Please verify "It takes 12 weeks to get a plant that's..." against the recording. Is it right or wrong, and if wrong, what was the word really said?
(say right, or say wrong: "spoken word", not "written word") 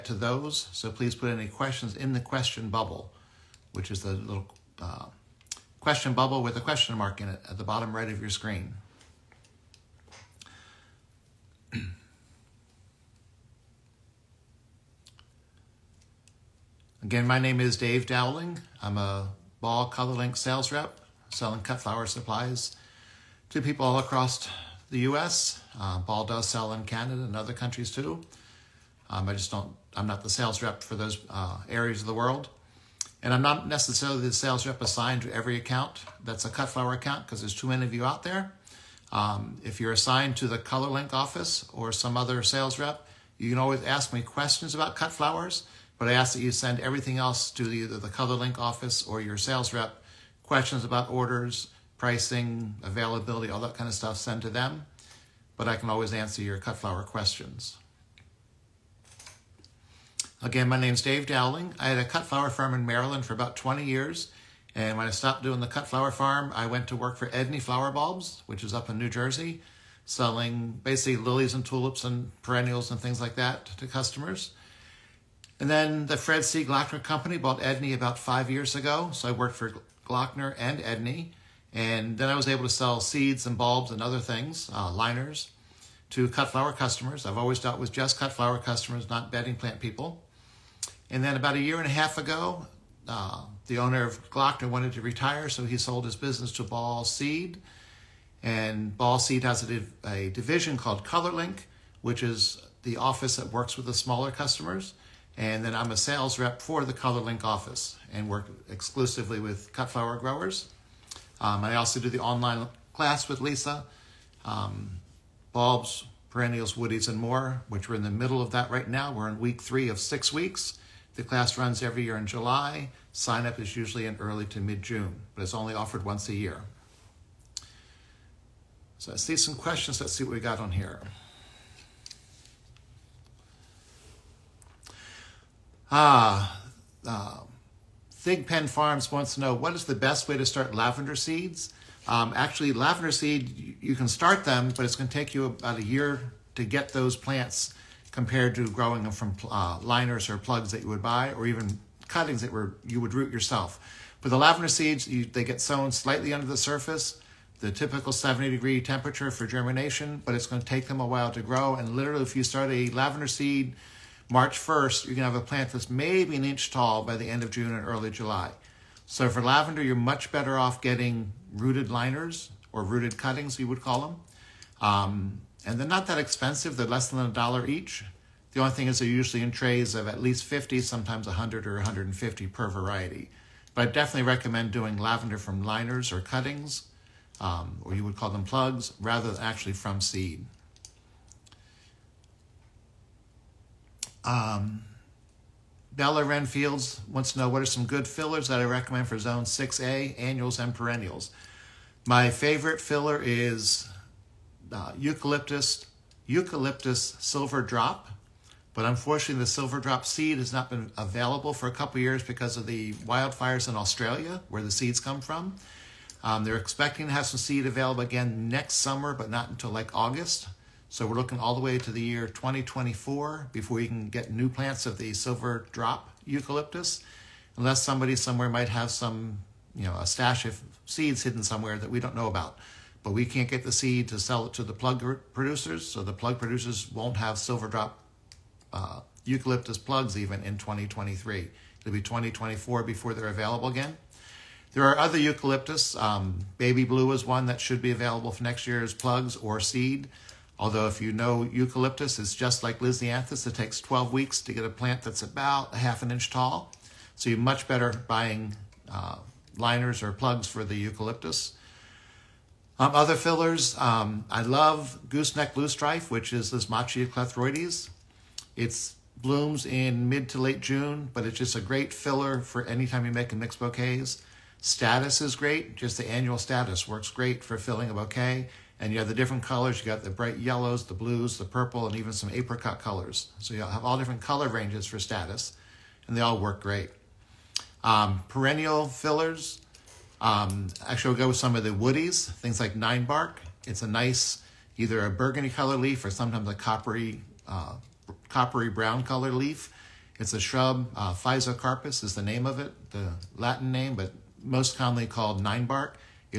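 right.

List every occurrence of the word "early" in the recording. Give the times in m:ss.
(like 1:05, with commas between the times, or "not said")
2:04, 2:47.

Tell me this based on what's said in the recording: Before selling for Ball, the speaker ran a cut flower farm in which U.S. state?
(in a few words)
Maryland.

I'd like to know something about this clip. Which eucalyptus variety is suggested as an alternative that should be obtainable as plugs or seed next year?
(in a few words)
Baby Blue.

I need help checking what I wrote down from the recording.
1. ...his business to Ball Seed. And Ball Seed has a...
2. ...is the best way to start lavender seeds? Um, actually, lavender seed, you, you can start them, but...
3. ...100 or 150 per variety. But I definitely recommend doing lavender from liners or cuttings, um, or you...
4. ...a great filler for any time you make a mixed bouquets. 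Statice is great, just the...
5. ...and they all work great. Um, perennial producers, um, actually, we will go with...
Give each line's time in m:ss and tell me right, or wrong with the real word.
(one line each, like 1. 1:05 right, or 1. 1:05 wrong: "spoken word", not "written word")
1. 1:36 right
2. 2:19 right
3. 3:01 right
4. 4:31 right
5. 4:46 wrong: "fillers", not "producers".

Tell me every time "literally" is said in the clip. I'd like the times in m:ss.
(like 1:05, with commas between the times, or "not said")
2:41.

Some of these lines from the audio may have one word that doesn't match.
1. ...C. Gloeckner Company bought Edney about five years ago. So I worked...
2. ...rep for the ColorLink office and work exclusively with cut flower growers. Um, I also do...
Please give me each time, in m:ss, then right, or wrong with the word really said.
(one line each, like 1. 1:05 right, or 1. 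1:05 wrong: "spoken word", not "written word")
1. 1:16 right
2. 1:46 right.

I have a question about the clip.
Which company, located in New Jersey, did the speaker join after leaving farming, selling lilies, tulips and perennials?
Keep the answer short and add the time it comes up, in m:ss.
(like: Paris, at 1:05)
Edney Flower Bulbs, at 1:07.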